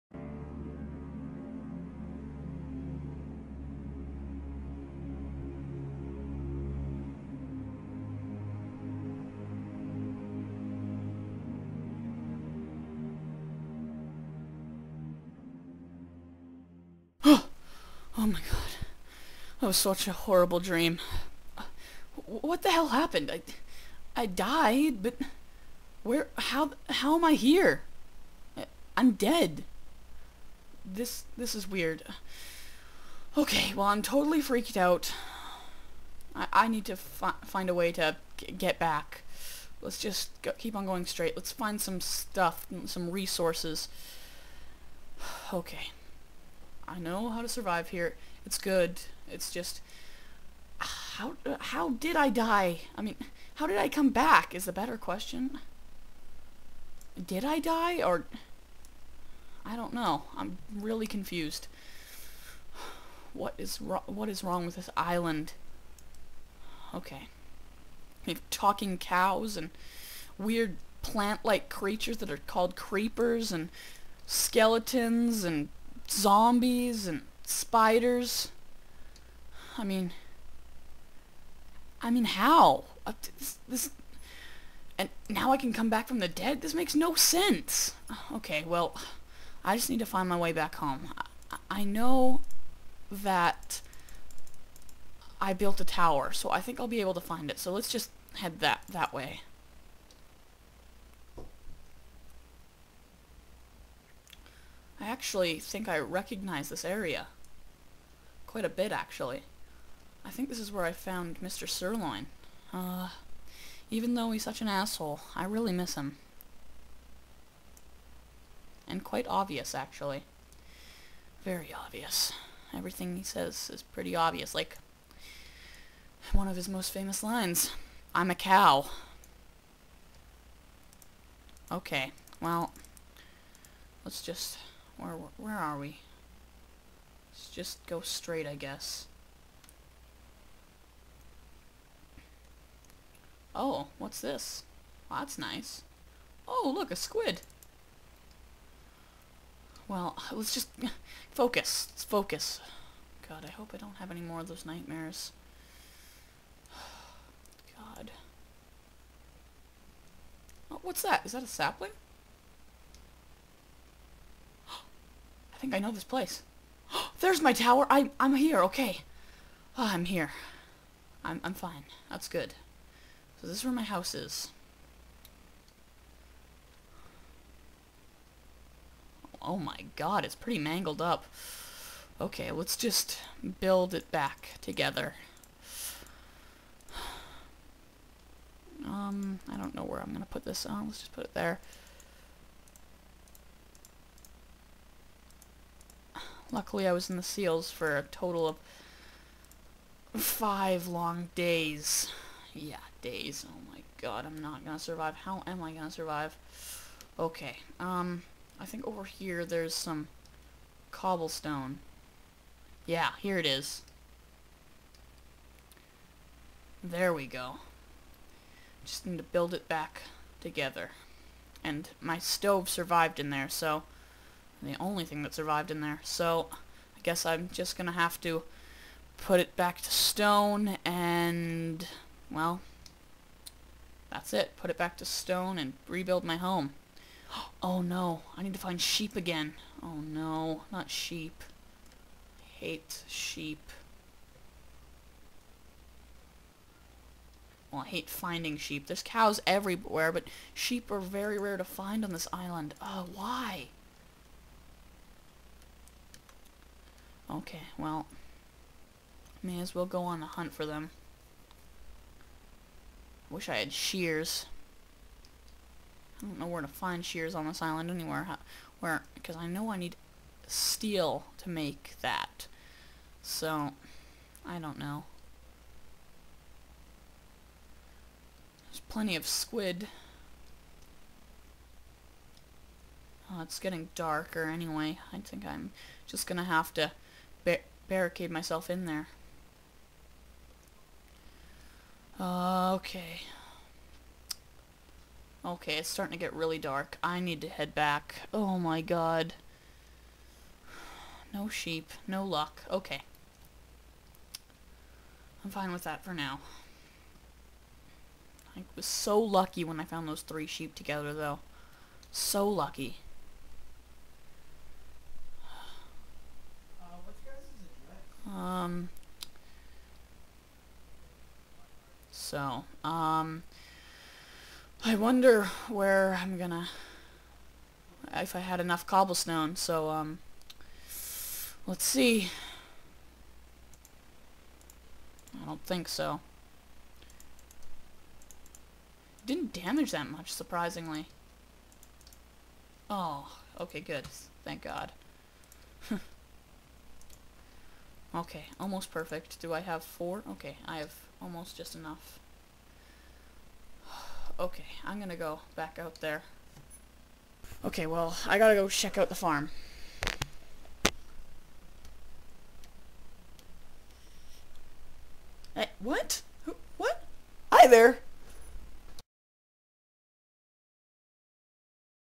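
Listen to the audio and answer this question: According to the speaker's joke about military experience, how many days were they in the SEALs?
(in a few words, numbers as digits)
5.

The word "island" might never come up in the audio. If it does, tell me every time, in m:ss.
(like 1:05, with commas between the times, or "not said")
1:04, 4:12, 4:27.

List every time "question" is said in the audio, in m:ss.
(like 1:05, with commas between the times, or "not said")
0:54.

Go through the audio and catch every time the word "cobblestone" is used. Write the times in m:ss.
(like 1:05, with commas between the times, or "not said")
3:30, 5:28.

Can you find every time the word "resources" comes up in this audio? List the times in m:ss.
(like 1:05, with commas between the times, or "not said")
0:43.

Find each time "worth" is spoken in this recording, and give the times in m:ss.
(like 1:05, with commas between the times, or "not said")
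not said.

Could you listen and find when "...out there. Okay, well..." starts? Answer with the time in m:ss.
5:55.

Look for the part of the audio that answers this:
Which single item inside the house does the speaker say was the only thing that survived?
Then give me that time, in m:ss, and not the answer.
3:42.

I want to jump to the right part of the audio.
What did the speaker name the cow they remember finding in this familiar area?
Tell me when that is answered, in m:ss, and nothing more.
1:51.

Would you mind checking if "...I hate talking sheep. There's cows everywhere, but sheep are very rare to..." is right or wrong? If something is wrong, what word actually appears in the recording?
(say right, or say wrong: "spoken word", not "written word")
wrong: "finding", not "talking".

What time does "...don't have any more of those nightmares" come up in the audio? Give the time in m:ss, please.
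2:33.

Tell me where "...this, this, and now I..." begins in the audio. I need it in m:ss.
1:23.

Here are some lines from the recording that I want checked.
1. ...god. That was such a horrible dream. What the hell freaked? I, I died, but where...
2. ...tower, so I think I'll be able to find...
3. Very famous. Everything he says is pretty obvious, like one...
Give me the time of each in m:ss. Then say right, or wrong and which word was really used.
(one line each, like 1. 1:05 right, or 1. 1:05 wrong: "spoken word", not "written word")
1. 0:18 wrong: "happened", not "freaked"
2. 1:35 right
3. 2:01 wrong: "obvious", not "famous".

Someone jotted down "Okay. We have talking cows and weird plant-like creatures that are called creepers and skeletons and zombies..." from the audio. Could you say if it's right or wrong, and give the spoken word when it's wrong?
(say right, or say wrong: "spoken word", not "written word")
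right.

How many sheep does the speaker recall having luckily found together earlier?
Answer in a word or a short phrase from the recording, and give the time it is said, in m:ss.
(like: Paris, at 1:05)
3, at 5:10.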